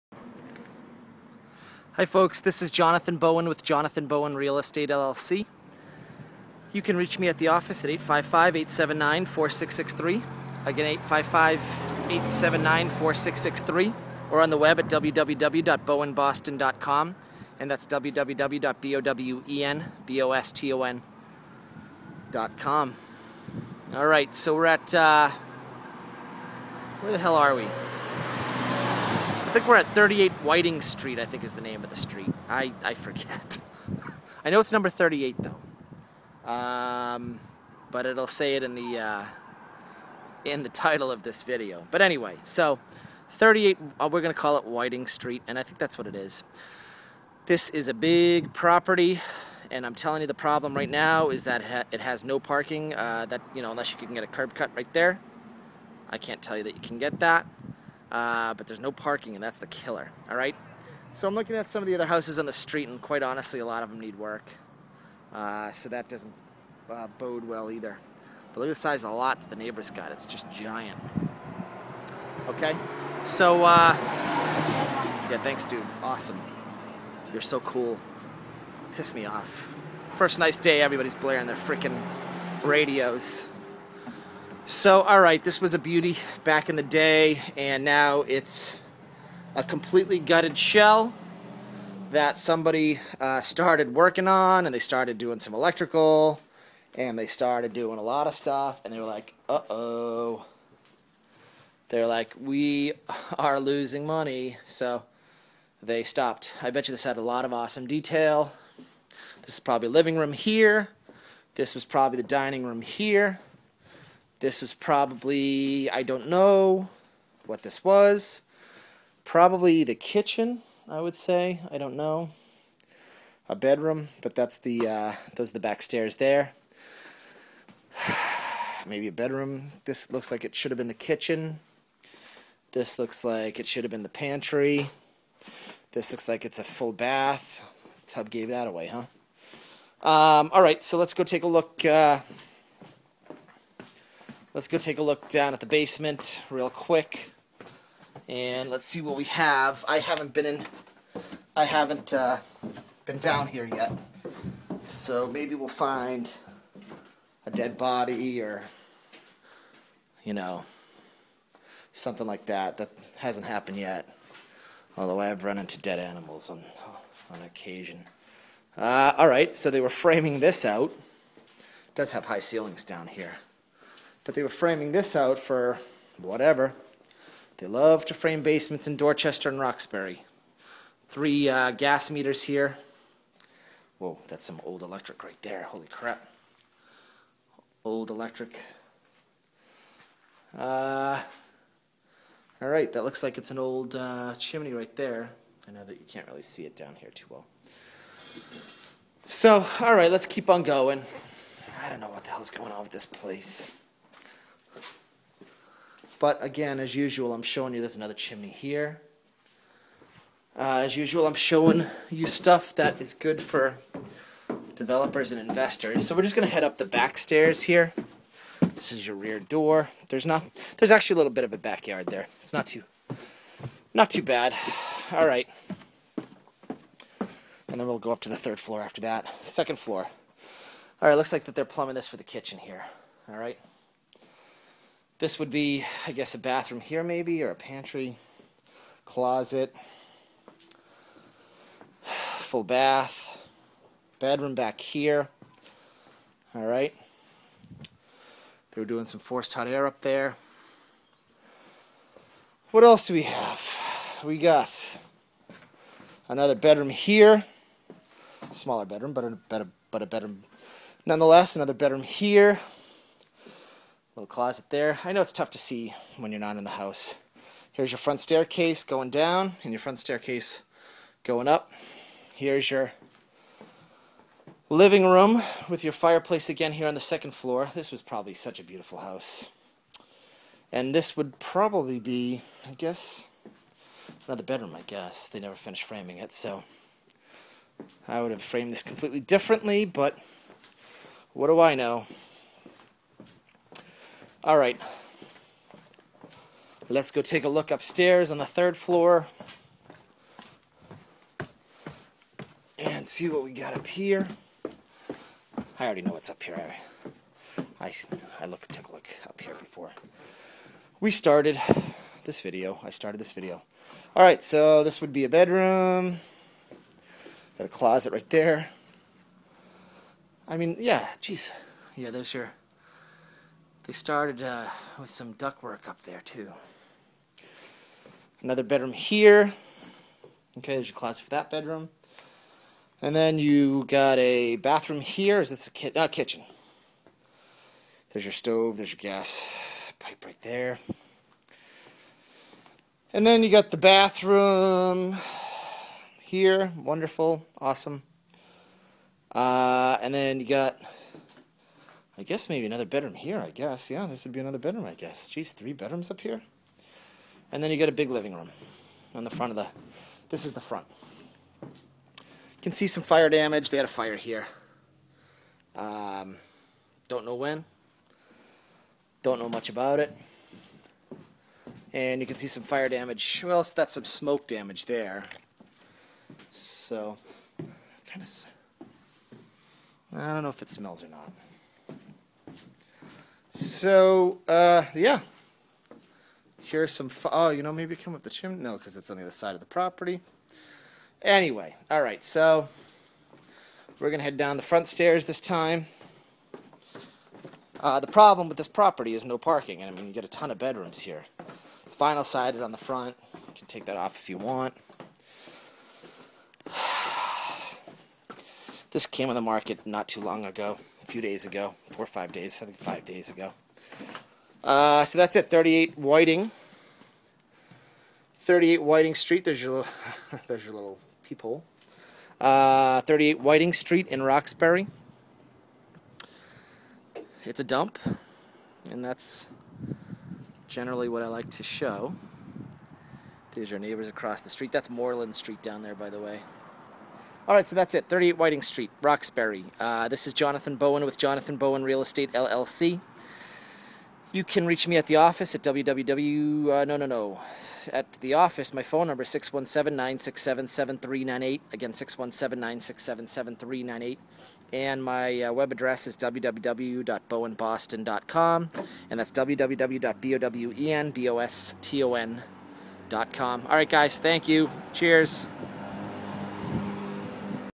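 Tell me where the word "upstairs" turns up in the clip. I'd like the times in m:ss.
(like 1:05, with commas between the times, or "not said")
4:57.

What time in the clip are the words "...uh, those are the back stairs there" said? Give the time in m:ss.
2:04.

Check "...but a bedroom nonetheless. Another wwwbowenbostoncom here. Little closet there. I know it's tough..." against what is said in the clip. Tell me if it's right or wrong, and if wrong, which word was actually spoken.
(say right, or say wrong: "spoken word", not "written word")
wrong: "bedroom", not "wwwbowenbostoncom".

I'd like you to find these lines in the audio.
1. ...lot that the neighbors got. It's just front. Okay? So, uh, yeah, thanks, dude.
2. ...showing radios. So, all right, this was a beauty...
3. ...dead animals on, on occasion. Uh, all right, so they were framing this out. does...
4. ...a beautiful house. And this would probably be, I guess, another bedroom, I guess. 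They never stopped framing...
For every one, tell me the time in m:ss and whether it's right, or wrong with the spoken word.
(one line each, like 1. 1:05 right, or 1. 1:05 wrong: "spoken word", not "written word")
1. 1:09 wrong: "giant", not "front"
2. 1:21 wrong: "freaking", not "showing"
3. 2:45 right
4. 4:38 wrong: "finished", not "stopped".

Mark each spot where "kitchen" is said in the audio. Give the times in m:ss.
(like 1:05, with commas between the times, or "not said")
1:59, 2:10, 3:52, 5:36.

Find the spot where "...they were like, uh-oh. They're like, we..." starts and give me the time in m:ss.
1:38.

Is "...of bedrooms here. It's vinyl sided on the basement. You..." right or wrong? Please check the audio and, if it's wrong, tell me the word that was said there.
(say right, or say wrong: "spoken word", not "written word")
wrong: "front", not "basement".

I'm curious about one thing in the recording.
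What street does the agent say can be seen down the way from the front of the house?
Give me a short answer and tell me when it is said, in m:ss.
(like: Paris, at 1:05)
Moreland Street, at 7:14.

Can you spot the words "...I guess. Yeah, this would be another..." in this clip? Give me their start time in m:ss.
5:53.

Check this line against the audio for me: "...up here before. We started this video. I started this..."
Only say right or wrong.
right.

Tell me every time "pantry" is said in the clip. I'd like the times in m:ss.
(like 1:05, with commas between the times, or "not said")
2:14, 3:57.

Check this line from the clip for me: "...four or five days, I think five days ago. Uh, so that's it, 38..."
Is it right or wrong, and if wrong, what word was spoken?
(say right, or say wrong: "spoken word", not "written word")
right.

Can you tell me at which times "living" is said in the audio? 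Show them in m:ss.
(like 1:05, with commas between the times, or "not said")
1:49, 4:34, 5:58.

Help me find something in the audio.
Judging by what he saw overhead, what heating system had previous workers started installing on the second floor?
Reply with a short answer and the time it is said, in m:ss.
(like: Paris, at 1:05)
Forced hot air, at 4:09.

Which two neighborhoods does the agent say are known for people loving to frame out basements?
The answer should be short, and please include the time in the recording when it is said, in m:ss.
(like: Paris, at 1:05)
Dorchester and Roxbury, at 2:58.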